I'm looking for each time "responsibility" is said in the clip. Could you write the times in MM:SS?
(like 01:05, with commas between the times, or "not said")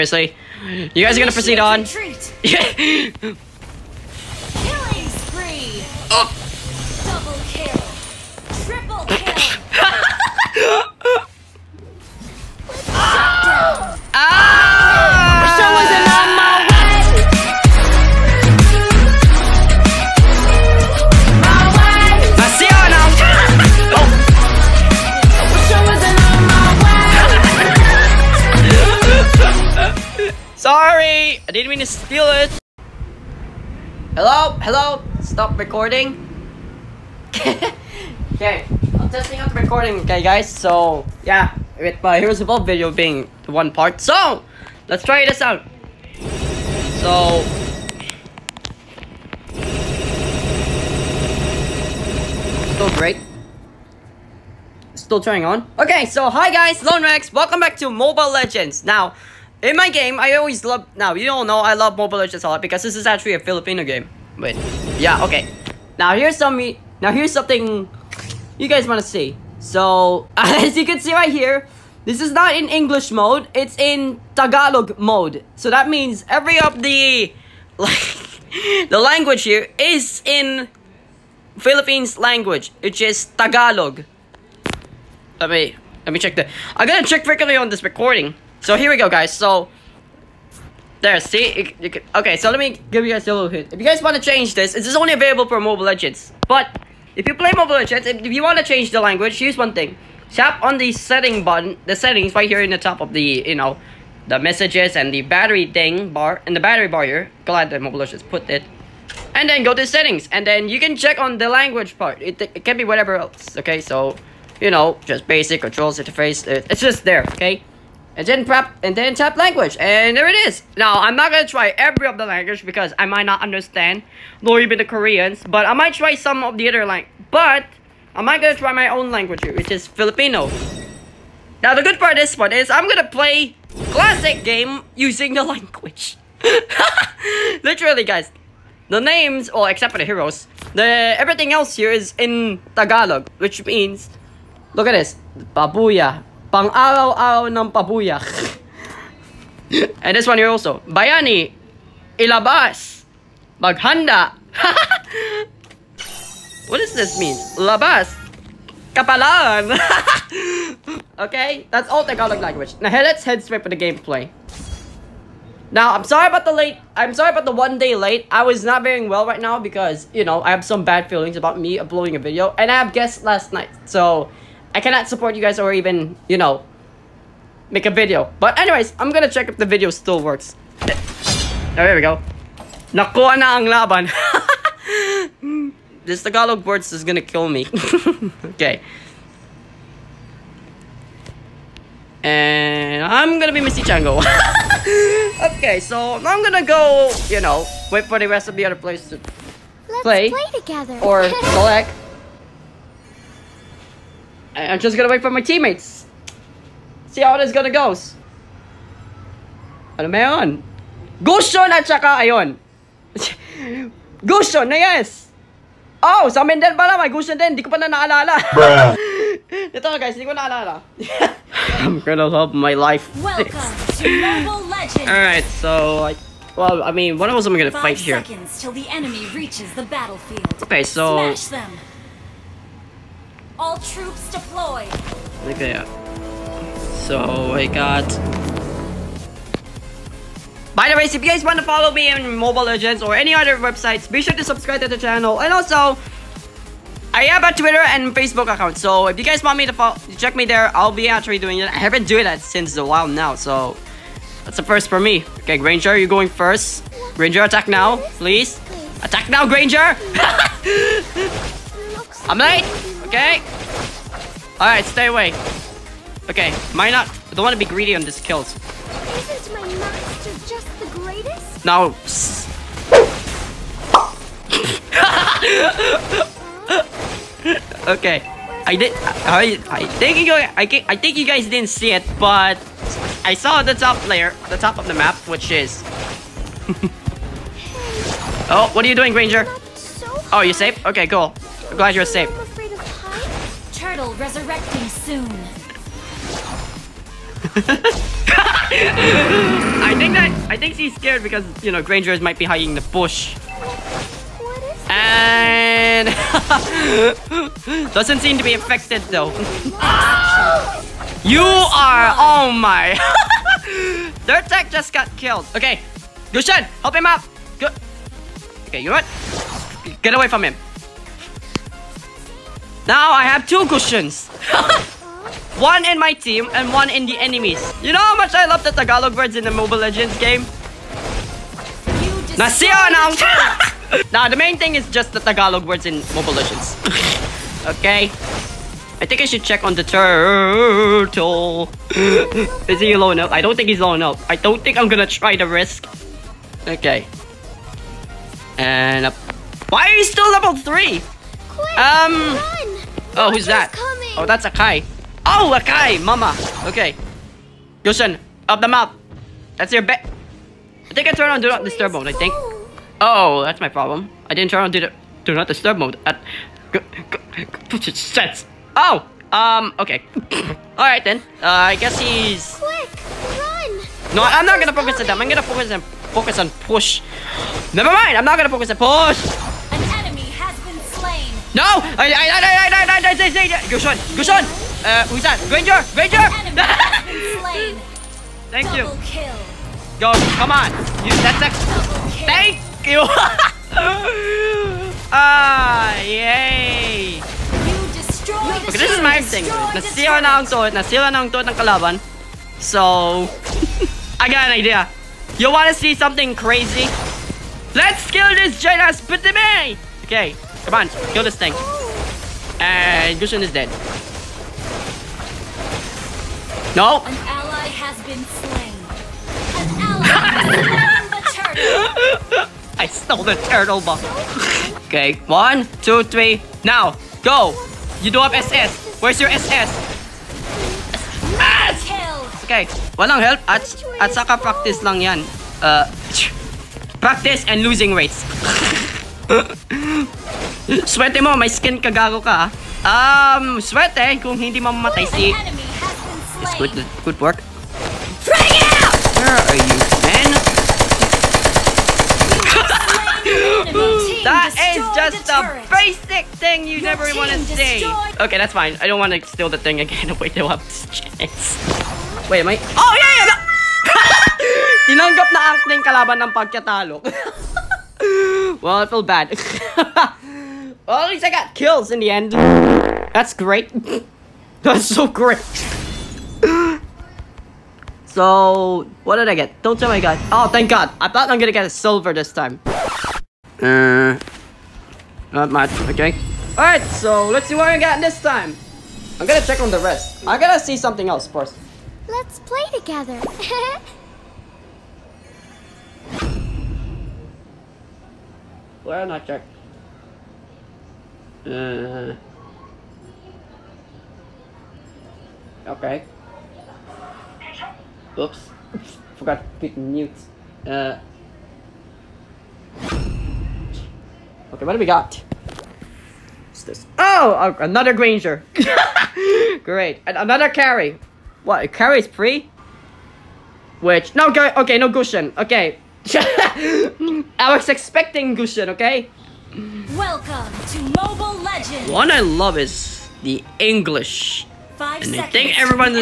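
not said.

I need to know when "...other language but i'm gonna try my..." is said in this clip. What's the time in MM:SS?
02:06.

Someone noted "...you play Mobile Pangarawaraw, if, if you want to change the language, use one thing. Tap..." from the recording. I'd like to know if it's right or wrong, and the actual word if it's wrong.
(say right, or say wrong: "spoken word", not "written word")
wrong: "Legends", not "Pangarawaraw".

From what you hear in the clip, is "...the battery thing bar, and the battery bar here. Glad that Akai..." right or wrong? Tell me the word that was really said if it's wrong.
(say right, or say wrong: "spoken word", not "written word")
wrong: "Mobile", not "Akai".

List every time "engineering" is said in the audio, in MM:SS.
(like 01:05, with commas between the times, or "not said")
not said.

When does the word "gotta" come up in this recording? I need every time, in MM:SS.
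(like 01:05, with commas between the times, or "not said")
01:26, 08:10.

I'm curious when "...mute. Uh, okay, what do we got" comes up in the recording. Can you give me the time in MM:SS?
08:29.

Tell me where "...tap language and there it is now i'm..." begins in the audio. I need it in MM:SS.
01:59.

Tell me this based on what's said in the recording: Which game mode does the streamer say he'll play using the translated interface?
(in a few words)
classic.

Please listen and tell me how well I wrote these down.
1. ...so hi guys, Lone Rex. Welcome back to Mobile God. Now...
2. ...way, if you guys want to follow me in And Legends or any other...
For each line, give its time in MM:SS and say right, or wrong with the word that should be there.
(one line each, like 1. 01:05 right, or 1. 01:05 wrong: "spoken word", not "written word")
1. 00:56 wrong: "Legends", not "God"
2. 04:00 wrong: "Mobile", not "And".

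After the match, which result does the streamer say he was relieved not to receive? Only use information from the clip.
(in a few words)
silver.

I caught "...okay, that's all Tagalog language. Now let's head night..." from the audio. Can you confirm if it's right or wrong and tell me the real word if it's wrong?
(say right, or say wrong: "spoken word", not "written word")
wrong: "straight", not "night".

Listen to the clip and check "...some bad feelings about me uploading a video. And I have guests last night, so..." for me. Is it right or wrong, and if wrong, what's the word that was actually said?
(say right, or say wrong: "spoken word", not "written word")
right.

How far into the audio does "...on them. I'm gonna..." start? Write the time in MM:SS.
06:15.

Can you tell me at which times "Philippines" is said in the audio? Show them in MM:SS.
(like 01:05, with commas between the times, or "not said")
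01:21.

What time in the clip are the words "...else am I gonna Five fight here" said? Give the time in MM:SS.
03:47.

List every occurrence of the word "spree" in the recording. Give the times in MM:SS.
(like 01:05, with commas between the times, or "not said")
00:05.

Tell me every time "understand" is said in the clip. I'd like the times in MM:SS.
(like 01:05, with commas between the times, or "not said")
02:03.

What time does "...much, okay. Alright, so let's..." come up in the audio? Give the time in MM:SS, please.
08:05.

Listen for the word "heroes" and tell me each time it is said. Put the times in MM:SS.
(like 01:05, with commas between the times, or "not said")
00:42, 02:20.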